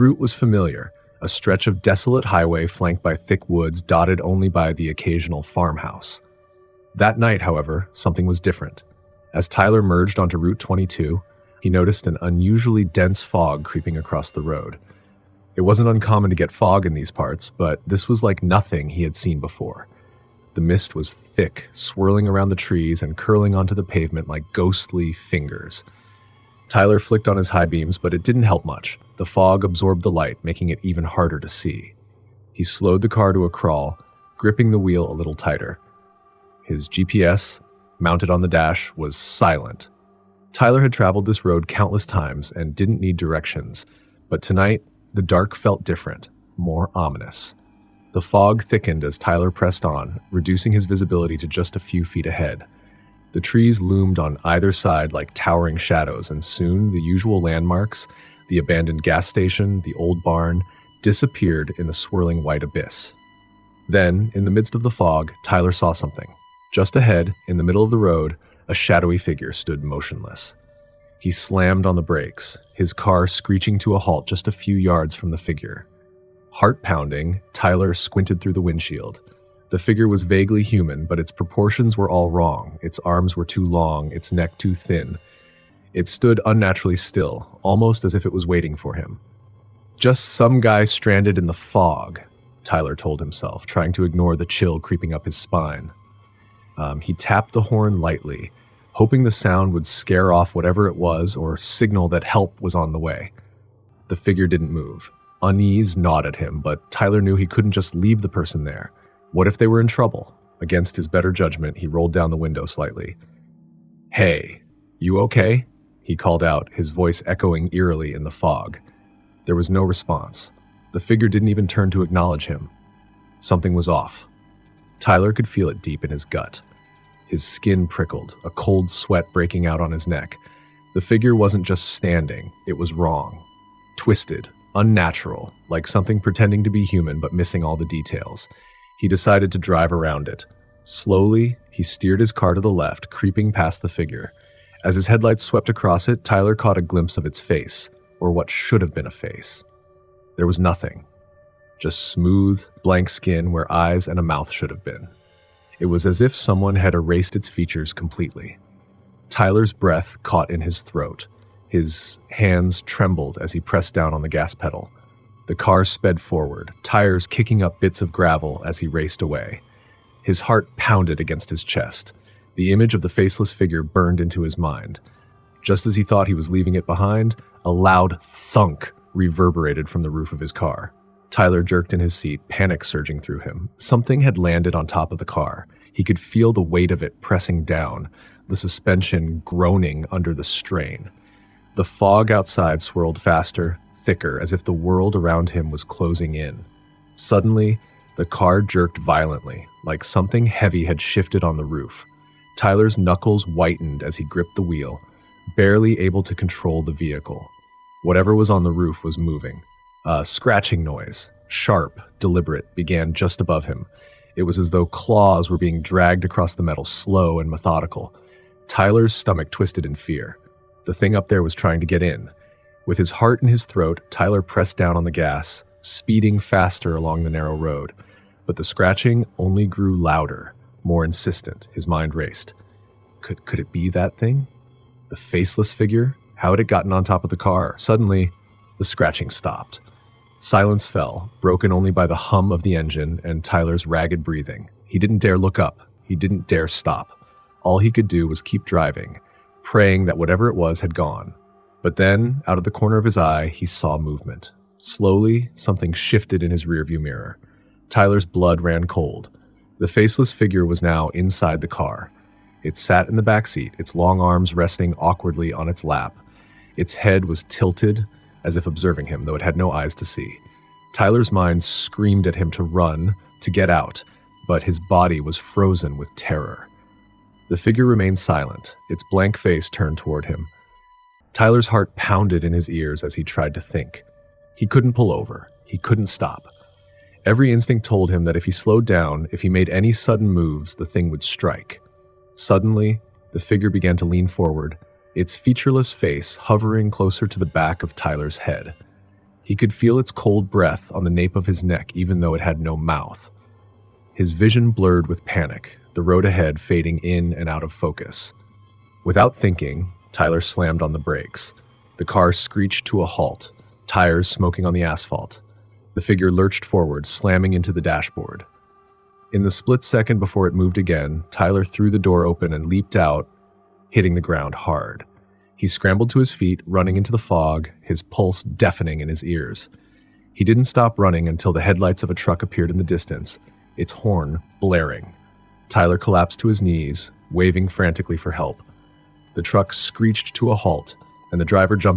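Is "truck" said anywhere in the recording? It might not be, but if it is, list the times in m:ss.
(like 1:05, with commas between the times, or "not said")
5:32, 5:39.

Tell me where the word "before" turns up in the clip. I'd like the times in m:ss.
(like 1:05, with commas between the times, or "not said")
0:19, 5:20.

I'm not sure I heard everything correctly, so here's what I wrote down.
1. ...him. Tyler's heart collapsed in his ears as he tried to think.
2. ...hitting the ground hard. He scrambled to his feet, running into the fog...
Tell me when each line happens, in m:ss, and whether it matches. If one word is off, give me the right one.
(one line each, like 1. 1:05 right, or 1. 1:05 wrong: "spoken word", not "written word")
1. 4:40 wrong: "pounded", not "collapsed"
2. 5:23 right.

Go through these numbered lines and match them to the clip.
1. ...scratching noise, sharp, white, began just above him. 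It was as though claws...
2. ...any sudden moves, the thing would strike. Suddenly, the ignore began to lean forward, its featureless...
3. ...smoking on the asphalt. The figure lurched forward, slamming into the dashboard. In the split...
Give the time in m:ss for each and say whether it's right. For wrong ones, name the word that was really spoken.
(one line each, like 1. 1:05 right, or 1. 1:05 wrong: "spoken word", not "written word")
1. 3:30 wrong: "deliberate", not "white"
2. 4:49 wrong: "figure", not "ignore"
3. 5:14 right.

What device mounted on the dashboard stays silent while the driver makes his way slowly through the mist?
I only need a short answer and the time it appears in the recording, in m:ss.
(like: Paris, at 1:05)
GPS, at 0:36.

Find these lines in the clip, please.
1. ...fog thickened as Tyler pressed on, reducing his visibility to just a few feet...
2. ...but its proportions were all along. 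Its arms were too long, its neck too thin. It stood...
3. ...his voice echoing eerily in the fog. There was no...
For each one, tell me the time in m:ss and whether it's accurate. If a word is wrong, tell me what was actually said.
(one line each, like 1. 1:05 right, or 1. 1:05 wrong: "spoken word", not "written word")
1. 0:48 right
2. 1:21 wrong: "wrong", not "along"
3. 1:56 right.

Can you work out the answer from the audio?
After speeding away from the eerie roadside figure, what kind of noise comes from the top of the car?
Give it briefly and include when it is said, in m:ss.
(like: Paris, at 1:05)
a loud thunk, at 2:57.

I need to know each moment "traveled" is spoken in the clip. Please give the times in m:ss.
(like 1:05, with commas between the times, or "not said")
0:40.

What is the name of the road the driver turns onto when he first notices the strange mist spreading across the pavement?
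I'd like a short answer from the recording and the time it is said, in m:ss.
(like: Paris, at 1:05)
Route 22, at 0:10.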